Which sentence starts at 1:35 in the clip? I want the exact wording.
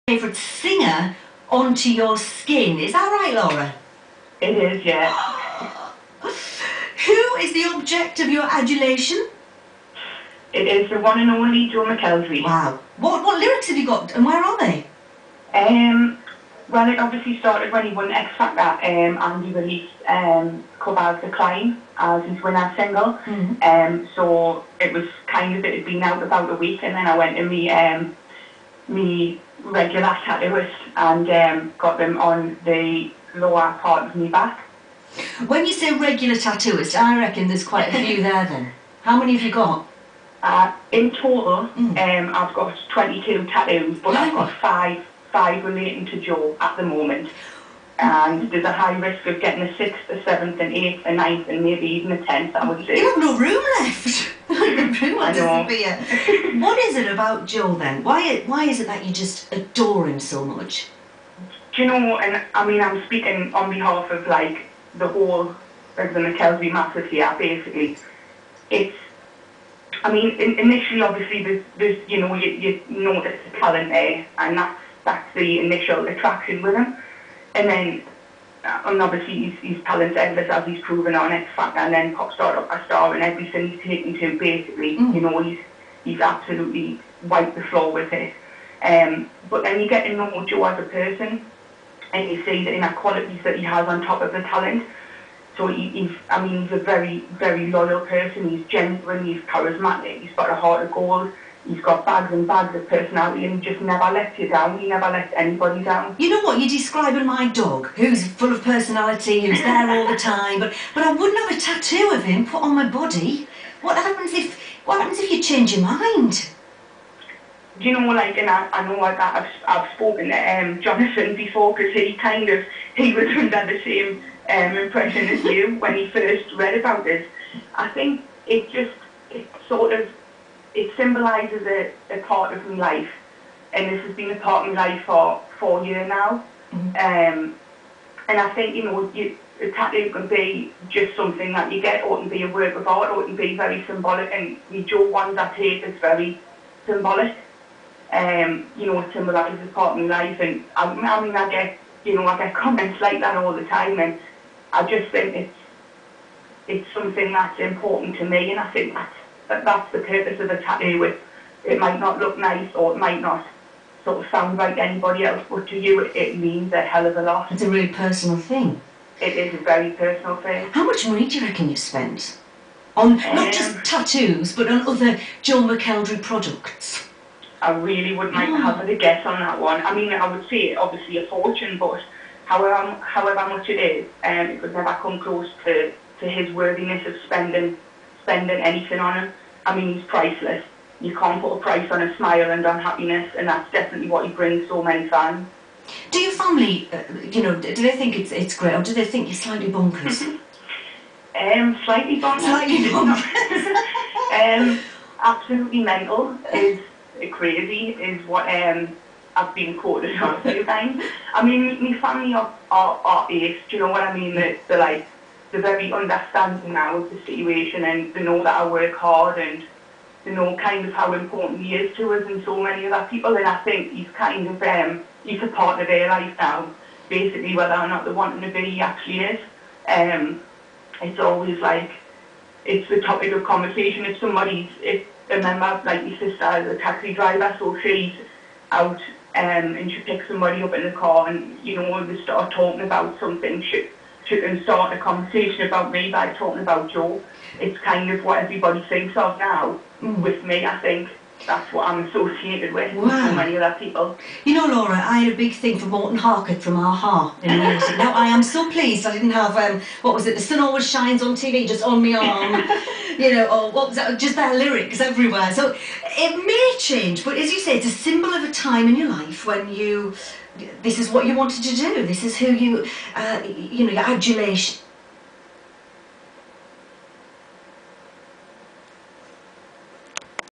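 So he, he's, I mean, he's a very, very loyal person.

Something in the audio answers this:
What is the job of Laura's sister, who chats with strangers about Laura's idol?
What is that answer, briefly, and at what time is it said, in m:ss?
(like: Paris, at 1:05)
Taxi driver, at 3:56.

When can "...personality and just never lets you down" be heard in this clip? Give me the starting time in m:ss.
1:42.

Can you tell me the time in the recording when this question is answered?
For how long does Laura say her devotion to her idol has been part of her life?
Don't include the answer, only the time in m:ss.
2:15.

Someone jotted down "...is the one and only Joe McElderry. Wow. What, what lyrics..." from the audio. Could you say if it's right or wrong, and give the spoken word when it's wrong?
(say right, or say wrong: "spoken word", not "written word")
right.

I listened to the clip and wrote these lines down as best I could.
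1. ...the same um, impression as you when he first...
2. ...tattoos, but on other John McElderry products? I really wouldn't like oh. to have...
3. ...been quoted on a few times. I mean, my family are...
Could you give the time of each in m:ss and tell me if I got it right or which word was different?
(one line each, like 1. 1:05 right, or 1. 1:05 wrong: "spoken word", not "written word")
1. 2:03 right
2. 2:53 right
3. 3:29 right.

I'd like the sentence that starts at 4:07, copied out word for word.
It's kind of what everybody thinks of now.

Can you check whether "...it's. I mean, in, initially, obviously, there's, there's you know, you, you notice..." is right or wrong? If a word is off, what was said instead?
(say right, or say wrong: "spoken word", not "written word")
right.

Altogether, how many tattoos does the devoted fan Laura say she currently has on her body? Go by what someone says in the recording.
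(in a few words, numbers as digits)
22.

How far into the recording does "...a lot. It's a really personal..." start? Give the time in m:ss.
2:47.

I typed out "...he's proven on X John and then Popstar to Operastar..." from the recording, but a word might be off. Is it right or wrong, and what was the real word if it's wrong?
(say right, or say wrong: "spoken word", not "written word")
wrong: "Factor", not "John".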